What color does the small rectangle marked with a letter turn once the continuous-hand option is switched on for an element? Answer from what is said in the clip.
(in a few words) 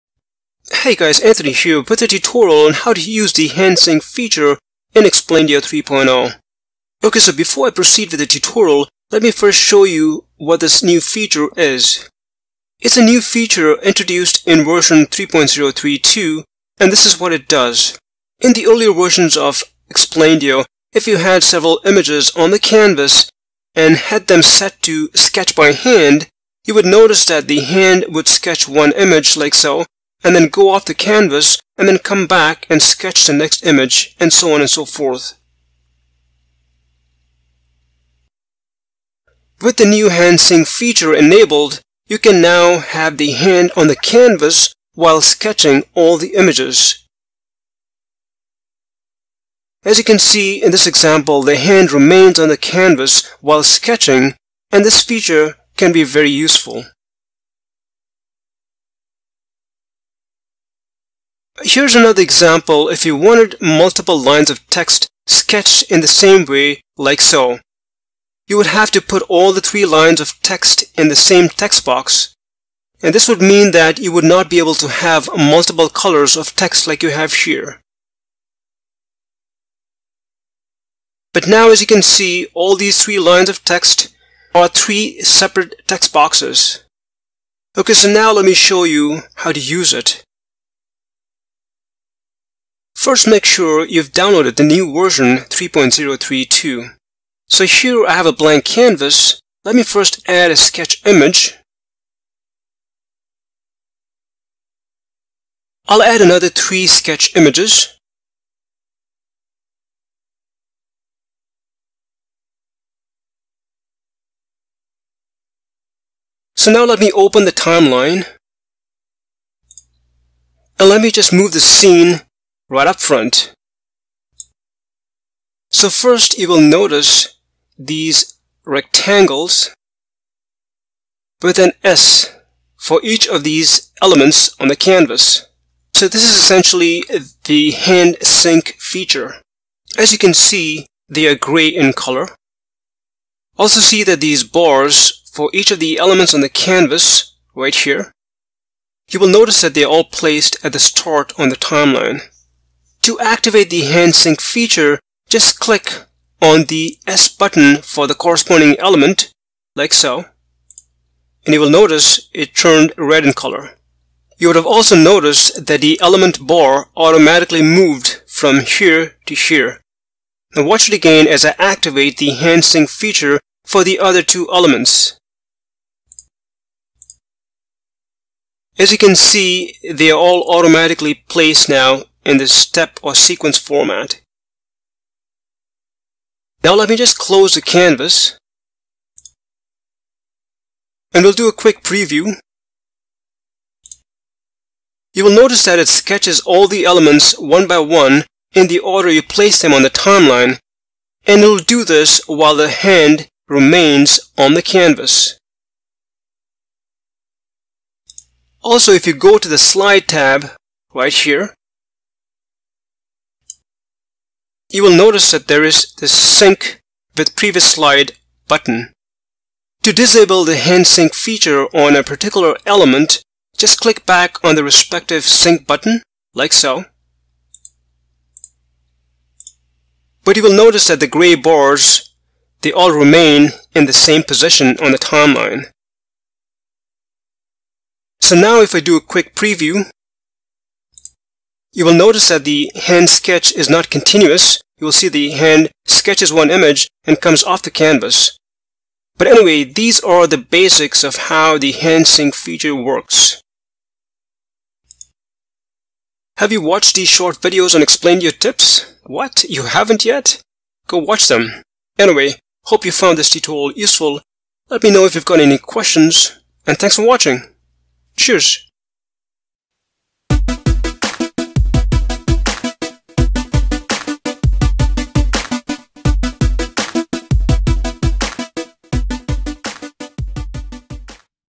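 Red.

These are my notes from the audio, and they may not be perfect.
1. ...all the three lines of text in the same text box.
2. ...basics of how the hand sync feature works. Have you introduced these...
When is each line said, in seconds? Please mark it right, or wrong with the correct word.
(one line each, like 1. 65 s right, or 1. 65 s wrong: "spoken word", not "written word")
1. 69 s right
2. 250 s wrong: "watched", not "introduced".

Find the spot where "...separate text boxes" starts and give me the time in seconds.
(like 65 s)
85 s.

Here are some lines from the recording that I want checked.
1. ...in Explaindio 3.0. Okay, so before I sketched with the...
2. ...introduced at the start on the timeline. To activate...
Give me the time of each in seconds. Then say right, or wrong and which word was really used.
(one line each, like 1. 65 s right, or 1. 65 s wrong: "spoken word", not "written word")
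1. 4 s wrong: "proceed", not "sketched"
2. 150 s wrong: "placed", not "introduced".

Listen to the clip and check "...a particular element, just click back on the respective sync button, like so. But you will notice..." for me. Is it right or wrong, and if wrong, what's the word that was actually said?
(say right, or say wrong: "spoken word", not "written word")
right.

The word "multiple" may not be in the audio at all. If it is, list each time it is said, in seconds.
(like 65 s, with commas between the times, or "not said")
63 s, 75 s.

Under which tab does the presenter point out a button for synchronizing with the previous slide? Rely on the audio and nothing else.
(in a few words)
Slide tab.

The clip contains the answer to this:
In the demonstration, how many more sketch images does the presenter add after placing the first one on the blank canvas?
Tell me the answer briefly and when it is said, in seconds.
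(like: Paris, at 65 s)
3, at 106 s.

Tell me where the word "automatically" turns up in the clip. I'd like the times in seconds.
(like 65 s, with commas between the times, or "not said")
166 s, 180 s.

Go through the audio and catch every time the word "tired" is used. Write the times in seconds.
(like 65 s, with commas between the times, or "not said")
not said.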